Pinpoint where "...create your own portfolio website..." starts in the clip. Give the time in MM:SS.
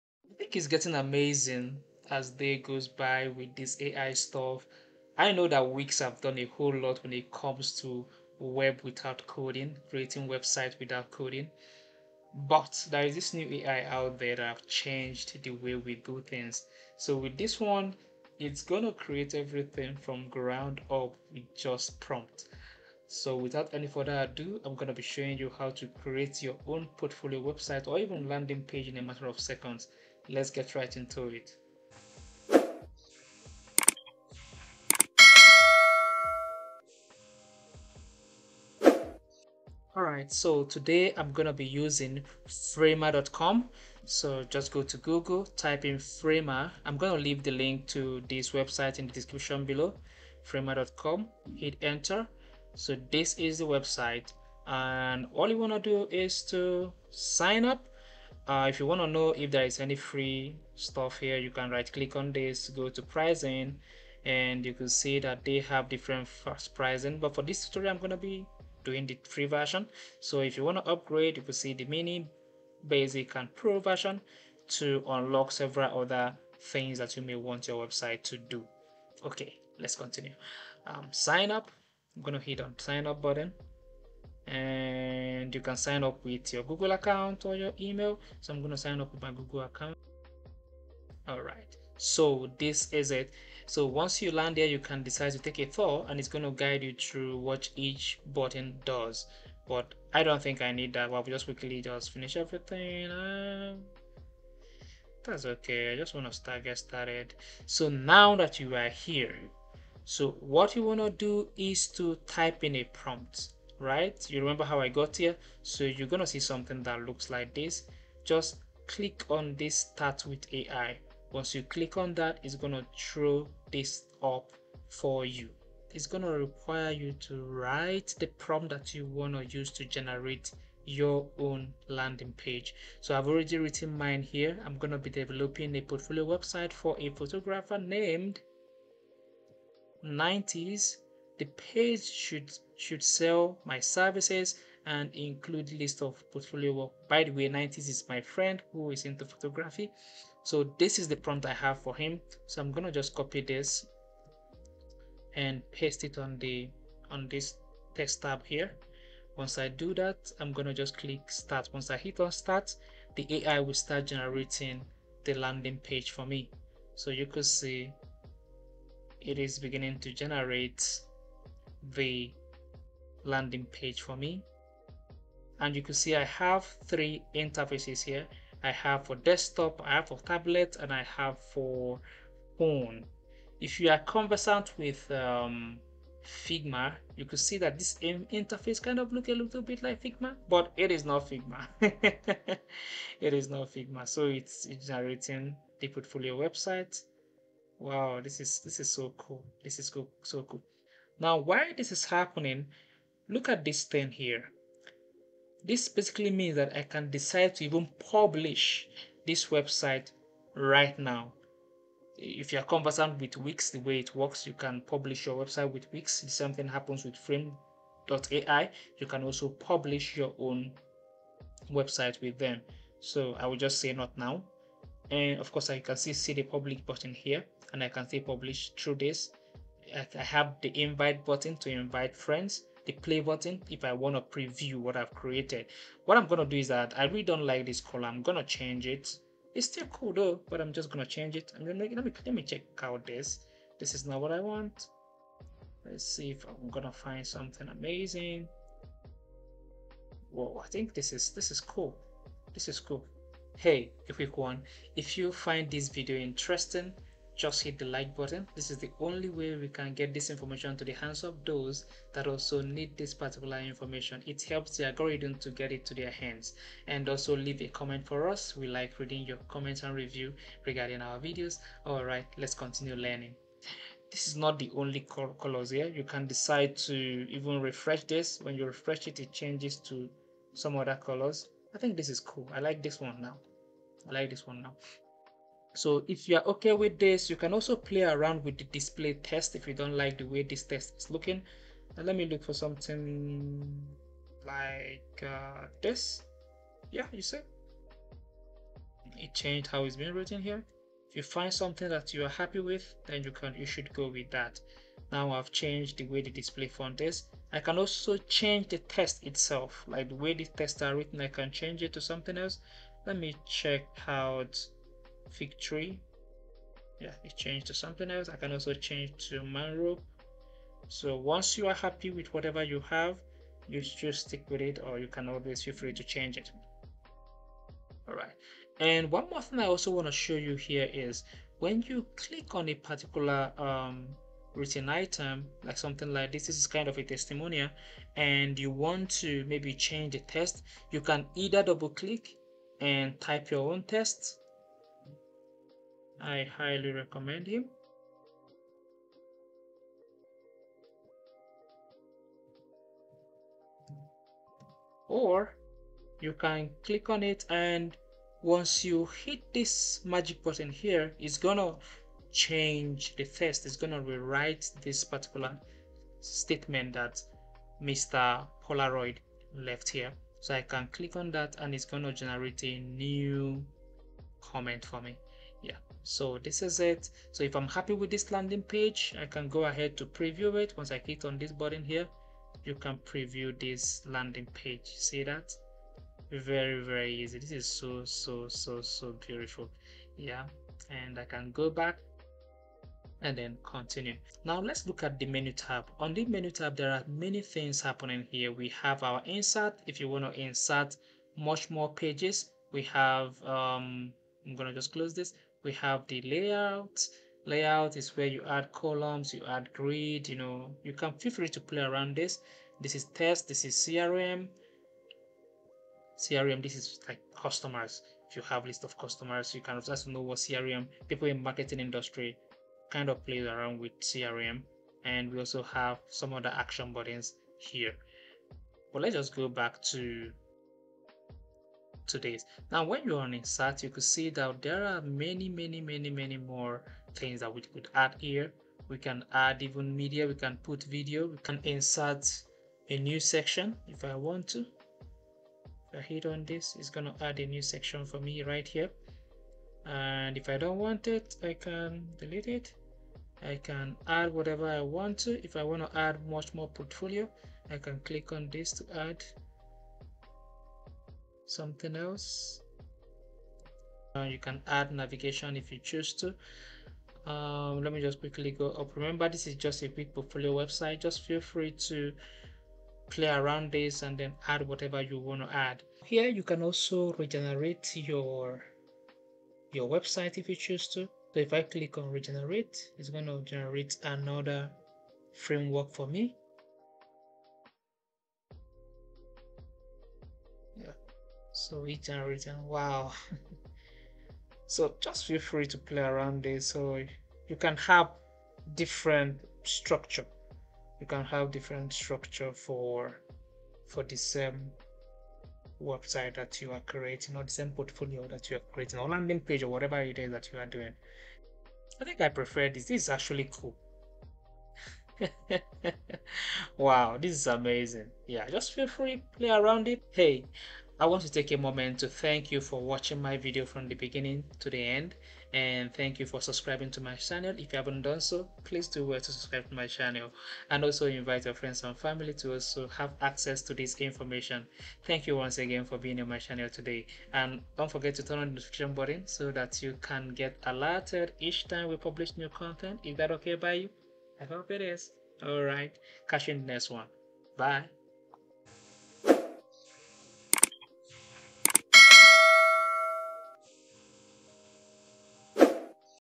00:25.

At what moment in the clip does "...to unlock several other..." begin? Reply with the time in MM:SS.
01:14.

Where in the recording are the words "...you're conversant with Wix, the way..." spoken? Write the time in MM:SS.
03:32.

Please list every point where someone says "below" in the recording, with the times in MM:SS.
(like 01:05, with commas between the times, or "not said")
00:49.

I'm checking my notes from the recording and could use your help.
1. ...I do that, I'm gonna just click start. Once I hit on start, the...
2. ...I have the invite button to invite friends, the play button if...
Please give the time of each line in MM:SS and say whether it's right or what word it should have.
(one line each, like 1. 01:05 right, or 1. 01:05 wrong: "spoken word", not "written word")
1. 02:39 right
2. 03:50 right.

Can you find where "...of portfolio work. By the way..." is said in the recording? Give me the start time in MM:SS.
02:26.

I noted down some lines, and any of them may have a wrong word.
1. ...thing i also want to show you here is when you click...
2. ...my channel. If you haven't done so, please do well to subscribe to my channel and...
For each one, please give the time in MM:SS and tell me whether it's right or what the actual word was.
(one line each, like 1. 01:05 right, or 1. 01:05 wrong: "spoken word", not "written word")
1. 05:29 right
2. 08:47 right.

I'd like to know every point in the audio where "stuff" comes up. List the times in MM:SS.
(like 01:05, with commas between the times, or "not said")
00:04, 01:00.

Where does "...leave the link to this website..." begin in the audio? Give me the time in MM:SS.
00:47.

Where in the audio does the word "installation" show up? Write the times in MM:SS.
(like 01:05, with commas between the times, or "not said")
not said.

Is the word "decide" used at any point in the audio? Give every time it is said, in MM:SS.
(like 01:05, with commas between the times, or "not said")
01:35, 03:27, 04:36.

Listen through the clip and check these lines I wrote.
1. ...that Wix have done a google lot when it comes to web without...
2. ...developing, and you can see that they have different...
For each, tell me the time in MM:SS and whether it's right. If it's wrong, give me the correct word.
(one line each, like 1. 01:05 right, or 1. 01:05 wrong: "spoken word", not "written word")
1. 00:05 wrong: "whole", not "google"
2. 01:03 wrong: "pricing", not "developing".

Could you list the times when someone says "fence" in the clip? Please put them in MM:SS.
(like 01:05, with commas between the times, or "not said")
not said.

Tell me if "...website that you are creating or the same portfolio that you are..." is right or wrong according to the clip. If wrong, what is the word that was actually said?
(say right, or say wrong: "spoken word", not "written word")
right.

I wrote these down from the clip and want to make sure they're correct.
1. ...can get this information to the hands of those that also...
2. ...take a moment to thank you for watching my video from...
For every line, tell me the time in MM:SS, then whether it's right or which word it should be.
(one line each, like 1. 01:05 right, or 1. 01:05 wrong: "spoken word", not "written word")
1. 04:19 right
2. 08:41 right.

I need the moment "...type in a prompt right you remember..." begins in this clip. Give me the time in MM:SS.
01:52.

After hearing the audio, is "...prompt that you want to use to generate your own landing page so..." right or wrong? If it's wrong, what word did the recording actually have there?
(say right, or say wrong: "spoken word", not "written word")
right.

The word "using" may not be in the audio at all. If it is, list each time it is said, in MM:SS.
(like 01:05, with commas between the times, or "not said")
00:41.